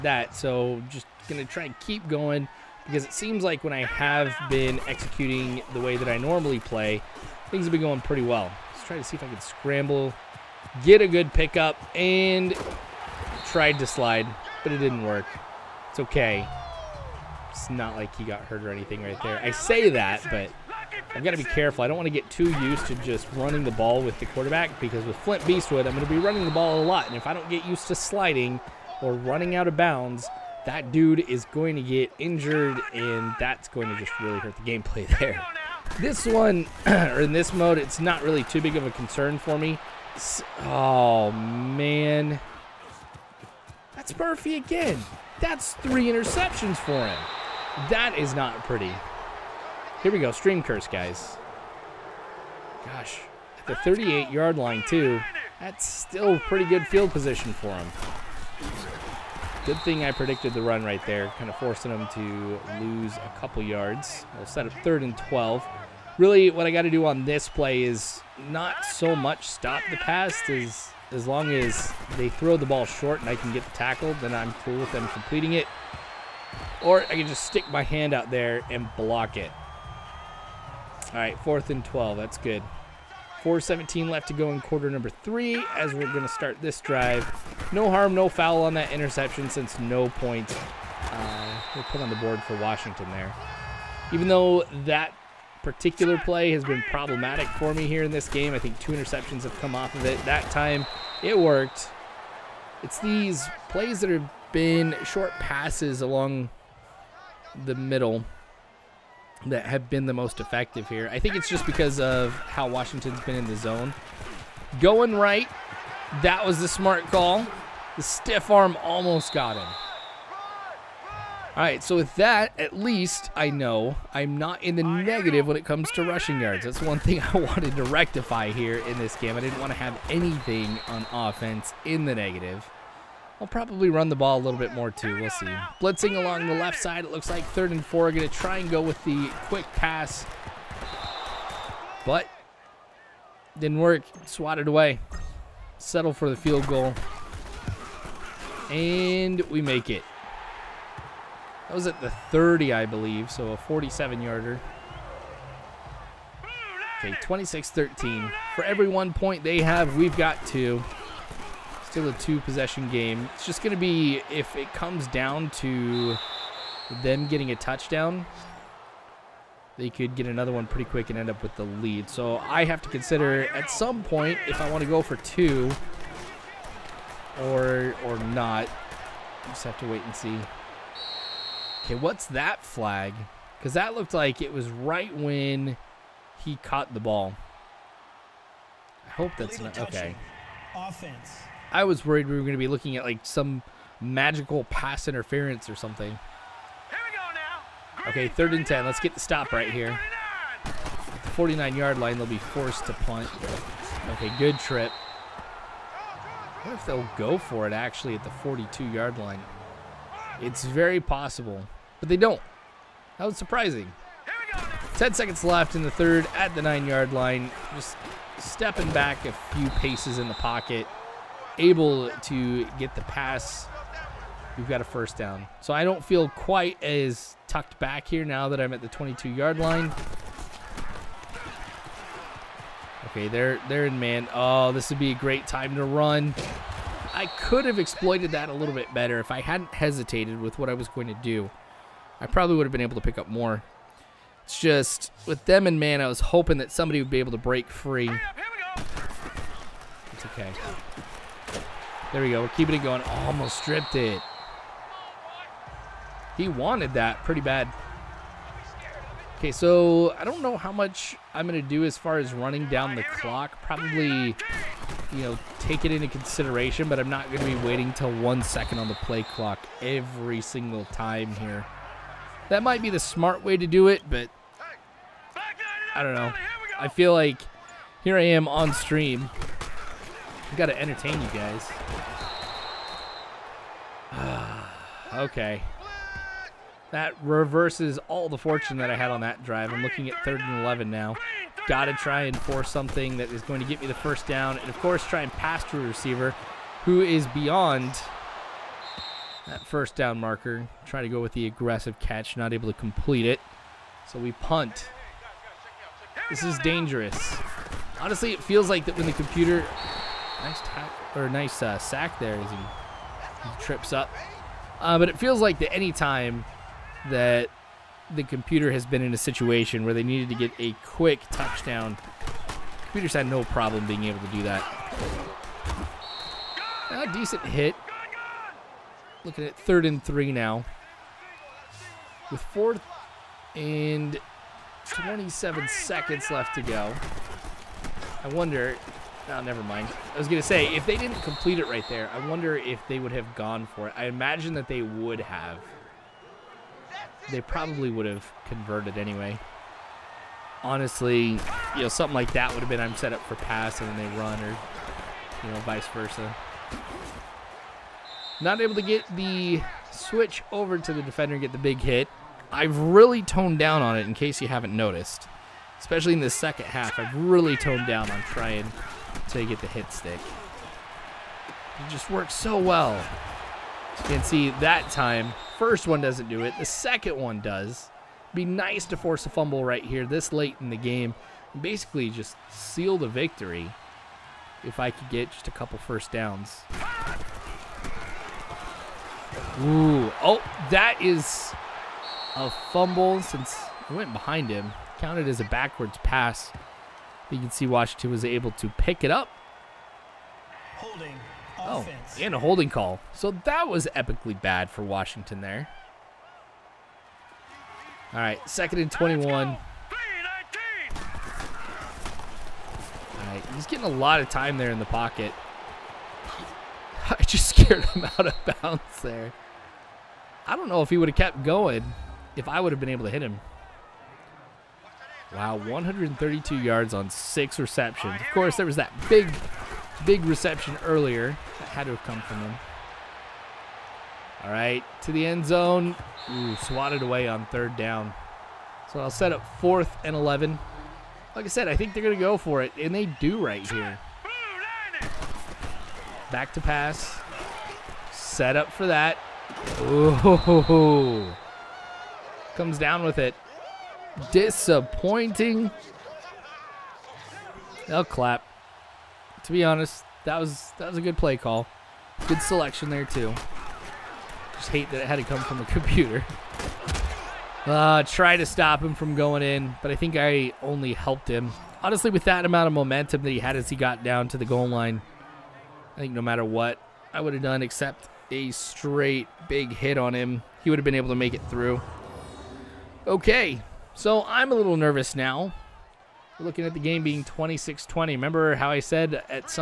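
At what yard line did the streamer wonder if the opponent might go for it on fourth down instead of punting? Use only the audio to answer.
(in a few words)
42.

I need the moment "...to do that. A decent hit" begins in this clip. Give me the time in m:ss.
5:24.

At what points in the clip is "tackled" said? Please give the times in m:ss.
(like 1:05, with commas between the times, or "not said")
1:13.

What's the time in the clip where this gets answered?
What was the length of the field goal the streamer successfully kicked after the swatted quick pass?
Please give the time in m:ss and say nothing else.
2:33.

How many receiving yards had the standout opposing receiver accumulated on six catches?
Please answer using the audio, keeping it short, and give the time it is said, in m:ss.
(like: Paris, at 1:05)
132, at 7:05.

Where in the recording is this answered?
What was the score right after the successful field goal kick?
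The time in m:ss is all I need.
2:37.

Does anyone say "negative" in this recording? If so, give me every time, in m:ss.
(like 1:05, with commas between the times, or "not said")
2:04, 2:12.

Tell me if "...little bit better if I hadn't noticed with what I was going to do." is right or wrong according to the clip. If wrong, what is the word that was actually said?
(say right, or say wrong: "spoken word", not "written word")
wrong: "hesitated", not "noticed".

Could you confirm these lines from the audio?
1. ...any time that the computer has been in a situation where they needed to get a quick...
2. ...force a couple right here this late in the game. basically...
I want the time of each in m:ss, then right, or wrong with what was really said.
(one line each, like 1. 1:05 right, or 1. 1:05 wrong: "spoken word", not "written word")
1. 5:15 right
2. 6:18 wrong: "fumble", not "couple".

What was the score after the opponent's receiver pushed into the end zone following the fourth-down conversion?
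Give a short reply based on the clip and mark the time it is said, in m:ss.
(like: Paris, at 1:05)
26-20, at 8:07.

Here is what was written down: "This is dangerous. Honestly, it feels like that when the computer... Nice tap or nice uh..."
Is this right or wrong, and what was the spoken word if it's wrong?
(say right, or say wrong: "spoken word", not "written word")
right.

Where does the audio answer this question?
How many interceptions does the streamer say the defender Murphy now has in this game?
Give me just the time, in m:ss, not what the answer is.
0:45.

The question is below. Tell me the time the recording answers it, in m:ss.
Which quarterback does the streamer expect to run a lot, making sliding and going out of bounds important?
0:25.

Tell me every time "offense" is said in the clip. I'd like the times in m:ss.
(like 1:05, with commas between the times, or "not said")
2:11, 3:10, 6:41.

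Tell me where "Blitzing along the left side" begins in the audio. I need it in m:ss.
2:15.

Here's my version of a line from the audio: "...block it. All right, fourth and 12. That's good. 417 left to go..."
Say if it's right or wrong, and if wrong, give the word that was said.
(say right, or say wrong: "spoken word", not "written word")
right.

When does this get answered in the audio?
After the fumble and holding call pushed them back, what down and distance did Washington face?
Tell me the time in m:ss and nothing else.
6:48.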